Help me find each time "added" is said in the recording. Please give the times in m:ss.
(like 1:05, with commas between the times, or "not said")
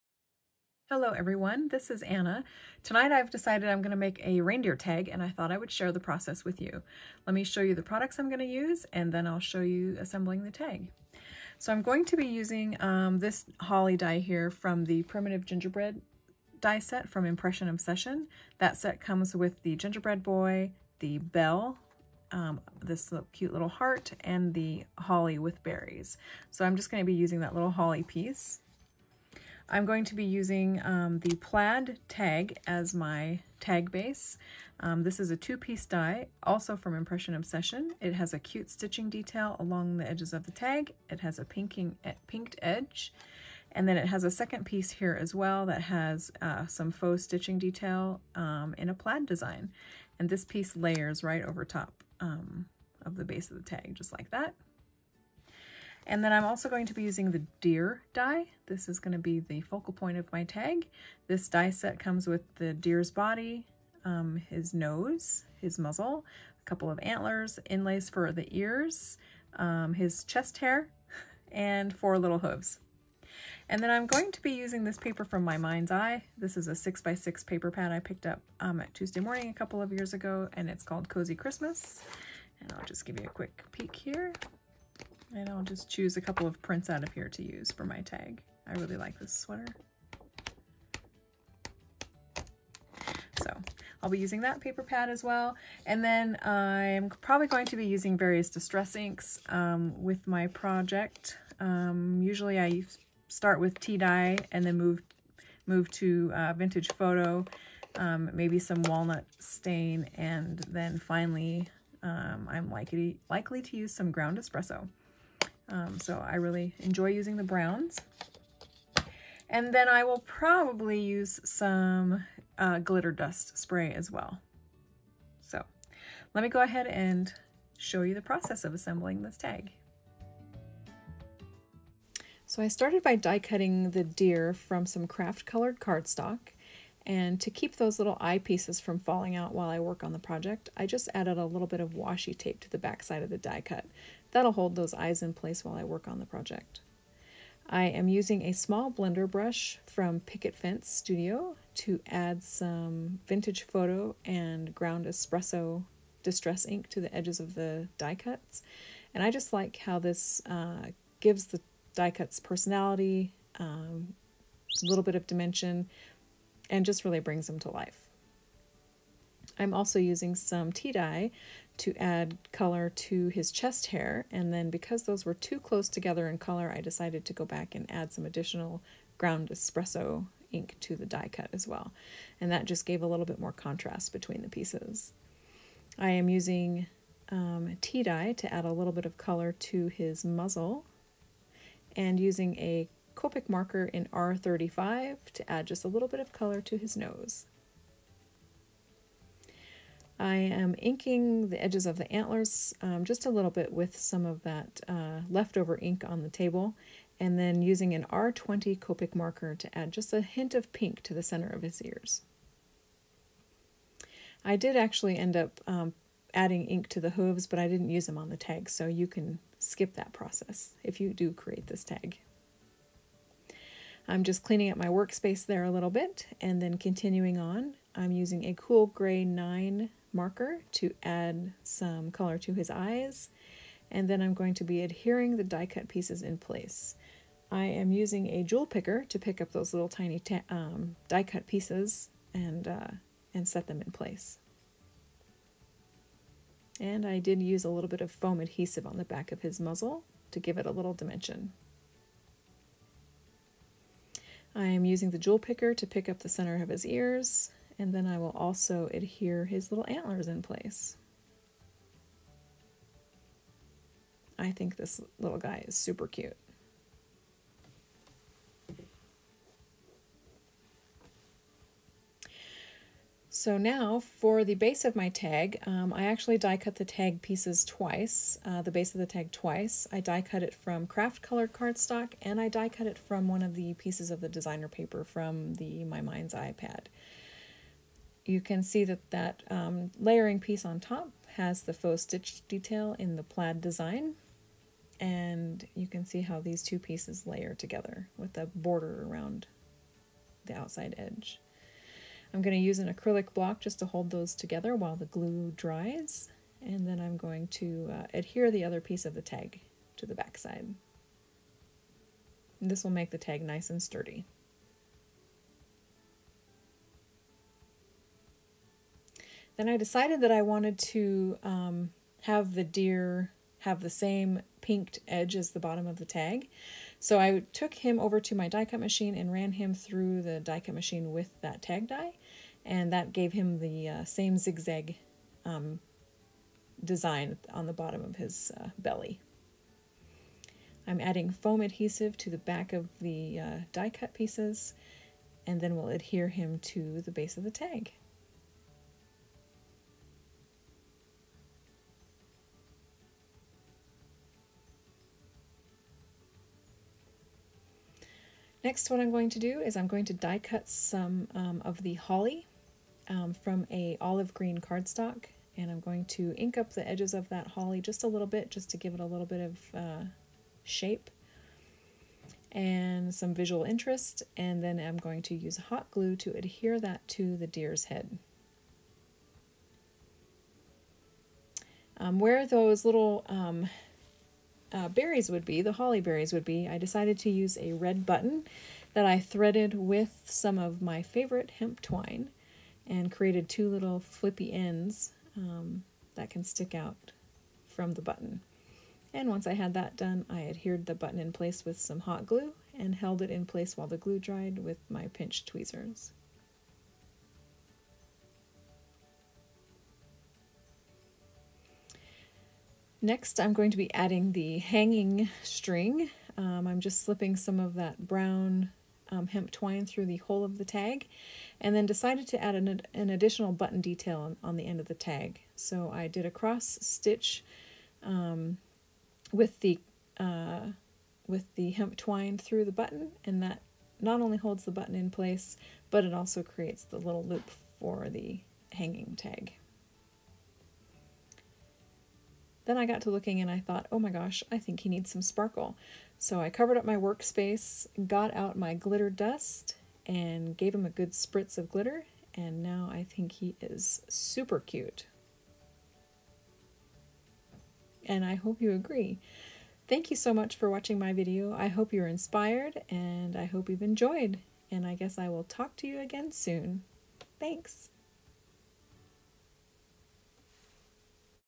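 2:21.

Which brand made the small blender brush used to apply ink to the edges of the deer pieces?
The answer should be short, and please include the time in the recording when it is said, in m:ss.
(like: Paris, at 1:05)
Picket Fence Studio, at 2:30.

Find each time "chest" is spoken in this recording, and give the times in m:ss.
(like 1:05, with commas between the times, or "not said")
1:10, 2:53.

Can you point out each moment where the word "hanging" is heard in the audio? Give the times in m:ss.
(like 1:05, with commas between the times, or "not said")
6:54, 7:18.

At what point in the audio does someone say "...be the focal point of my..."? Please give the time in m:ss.
0:59.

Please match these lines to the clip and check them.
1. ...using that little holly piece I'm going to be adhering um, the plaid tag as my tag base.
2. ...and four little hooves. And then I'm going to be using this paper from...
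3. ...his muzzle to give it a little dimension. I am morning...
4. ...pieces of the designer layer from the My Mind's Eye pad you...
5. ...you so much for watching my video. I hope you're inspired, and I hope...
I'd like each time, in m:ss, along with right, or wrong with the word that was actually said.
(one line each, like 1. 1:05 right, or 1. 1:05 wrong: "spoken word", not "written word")
1. 0:27 wrong: "using", not "adhering"
2. 1:11 right
3. 4:09 wrong: "using", not "morning"
4. 4:43 wrong: "paper", not "layer"
5. 7:40 right.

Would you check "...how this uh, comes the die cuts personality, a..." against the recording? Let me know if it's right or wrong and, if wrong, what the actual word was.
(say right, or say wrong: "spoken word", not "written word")
wrong: "gives", not "comes".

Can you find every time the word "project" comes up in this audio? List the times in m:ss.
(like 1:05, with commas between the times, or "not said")
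1:40, 2:20, 2:26.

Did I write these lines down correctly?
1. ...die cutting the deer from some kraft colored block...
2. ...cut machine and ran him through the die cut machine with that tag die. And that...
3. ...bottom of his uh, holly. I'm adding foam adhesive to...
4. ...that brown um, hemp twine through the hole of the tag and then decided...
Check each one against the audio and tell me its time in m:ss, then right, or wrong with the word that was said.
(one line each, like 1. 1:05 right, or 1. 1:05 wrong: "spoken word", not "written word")
1. 2:13 wrong: "cardstock", not "block"
2. 5:28 right
3. 5:37 wrong: "belly", not "holly"
4. 6:57 right.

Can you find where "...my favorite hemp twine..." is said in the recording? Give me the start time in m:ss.
6:30.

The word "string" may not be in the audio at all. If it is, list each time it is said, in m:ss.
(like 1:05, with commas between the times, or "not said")
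6:55.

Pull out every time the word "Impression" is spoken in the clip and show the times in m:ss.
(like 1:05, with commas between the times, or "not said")
0:17, 0:36.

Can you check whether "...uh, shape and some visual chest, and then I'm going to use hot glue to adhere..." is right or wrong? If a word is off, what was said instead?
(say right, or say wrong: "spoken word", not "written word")
wrong: "interest", not "chest".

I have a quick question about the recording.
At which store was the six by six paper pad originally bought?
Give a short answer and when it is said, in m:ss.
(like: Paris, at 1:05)
Tuesday Morning, at 1:18.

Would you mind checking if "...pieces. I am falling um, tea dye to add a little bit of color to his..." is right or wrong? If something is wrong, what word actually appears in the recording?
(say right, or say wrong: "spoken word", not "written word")
wrong: "using", not "falling".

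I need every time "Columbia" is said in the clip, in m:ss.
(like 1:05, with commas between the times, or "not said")
not said.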